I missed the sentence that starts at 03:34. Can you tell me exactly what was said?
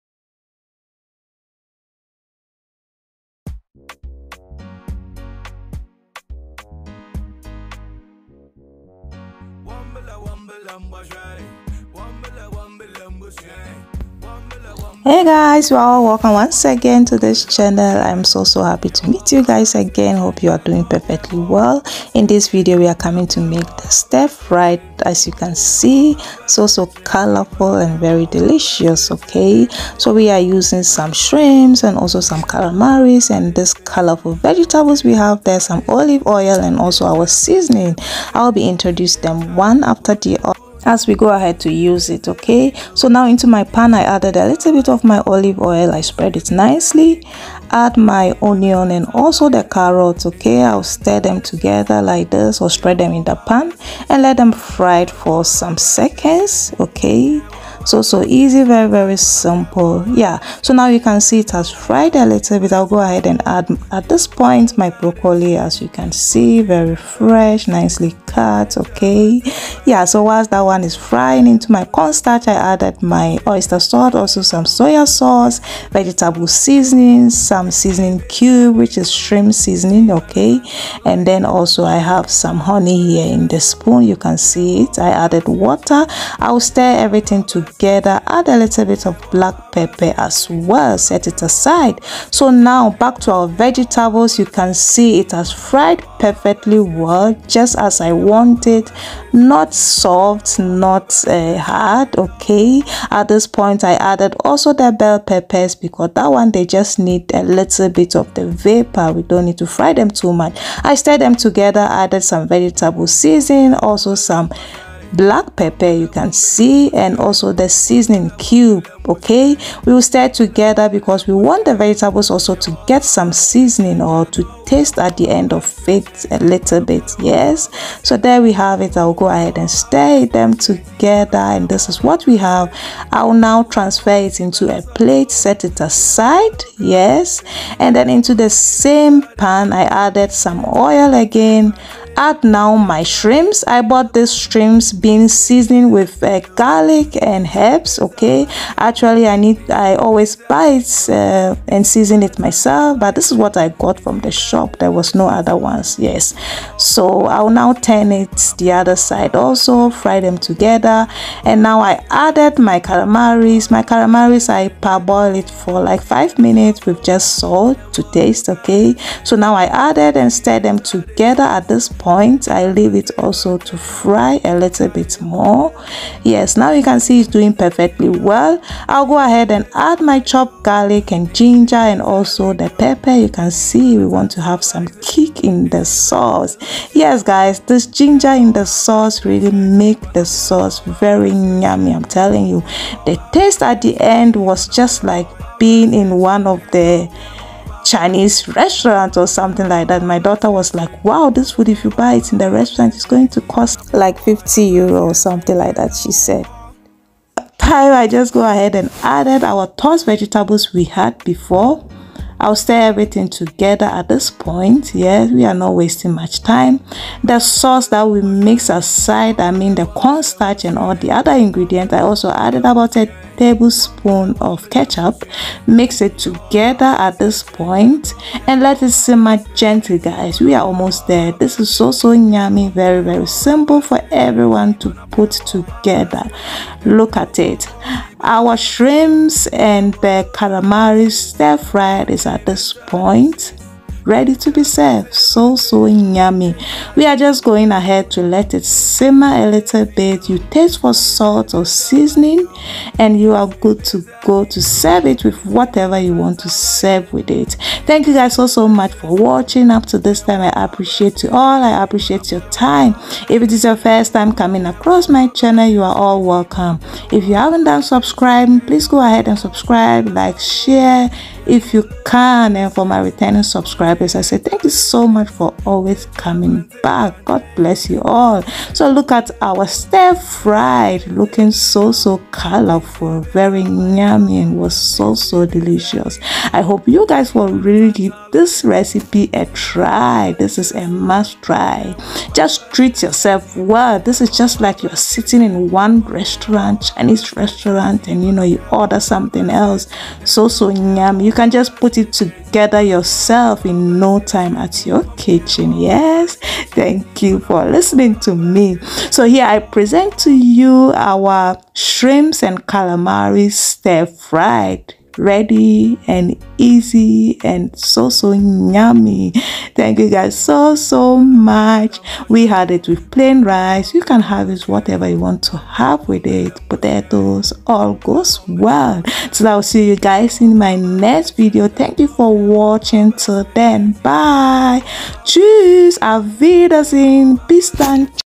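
Yes, we are not wasting much time.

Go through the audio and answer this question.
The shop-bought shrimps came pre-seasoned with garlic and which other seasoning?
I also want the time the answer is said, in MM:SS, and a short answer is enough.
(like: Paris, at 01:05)
herbs, at 02:27.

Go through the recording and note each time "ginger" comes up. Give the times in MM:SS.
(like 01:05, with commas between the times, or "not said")
03:01, 03:07.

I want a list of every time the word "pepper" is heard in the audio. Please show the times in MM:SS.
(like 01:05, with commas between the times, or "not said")
01:29, 01:45, 01:55, 03:02.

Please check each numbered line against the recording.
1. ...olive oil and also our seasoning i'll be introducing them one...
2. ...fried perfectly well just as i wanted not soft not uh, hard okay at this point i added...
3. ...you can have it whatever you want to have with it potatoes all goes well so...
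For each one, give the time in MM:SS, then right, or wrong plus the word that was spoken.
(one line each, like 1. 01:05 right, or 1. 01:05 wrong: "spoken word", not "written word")
1. 00:35 right
2. 01:35 right
3. 05:23 right.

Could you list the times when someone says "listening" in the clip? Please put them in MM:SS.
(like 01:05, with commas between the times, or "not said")
05:07.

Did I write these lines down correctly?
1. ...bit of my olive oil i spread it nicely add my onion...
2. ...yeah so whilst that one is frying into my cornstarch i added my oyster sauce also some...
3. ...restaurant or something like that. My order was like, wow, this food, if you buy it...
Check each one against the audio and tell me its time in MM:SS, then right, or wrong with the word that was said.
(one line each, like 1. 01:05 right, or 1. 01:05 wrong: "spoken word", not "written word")
1. 00:44 right
2. 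01:09 right
3. 03:18 wrong: "daughter", not "order".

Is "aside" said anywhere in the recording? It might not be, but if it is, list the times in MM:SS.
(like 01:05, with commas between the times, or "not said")
01:31, 02:15, 03:38.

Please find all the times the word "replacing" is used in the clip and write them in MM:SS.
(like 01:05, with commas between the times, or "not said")
not said.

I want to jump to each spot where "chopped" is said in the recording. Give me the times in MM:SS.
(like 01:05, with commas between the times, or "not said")
03:00.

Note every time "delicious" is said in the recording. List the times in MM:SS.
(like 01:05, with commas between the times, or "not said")
00:28, 04:45.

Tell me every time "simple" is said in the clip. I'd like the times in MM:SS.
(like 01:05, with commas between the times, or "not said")
00:59, 03:53.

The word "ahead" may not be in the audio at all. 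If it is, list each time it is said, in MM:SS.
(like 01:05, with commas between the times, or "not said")
00:41, 01:02, 02:09, 02:59, 03:28, 04:07, 04:29.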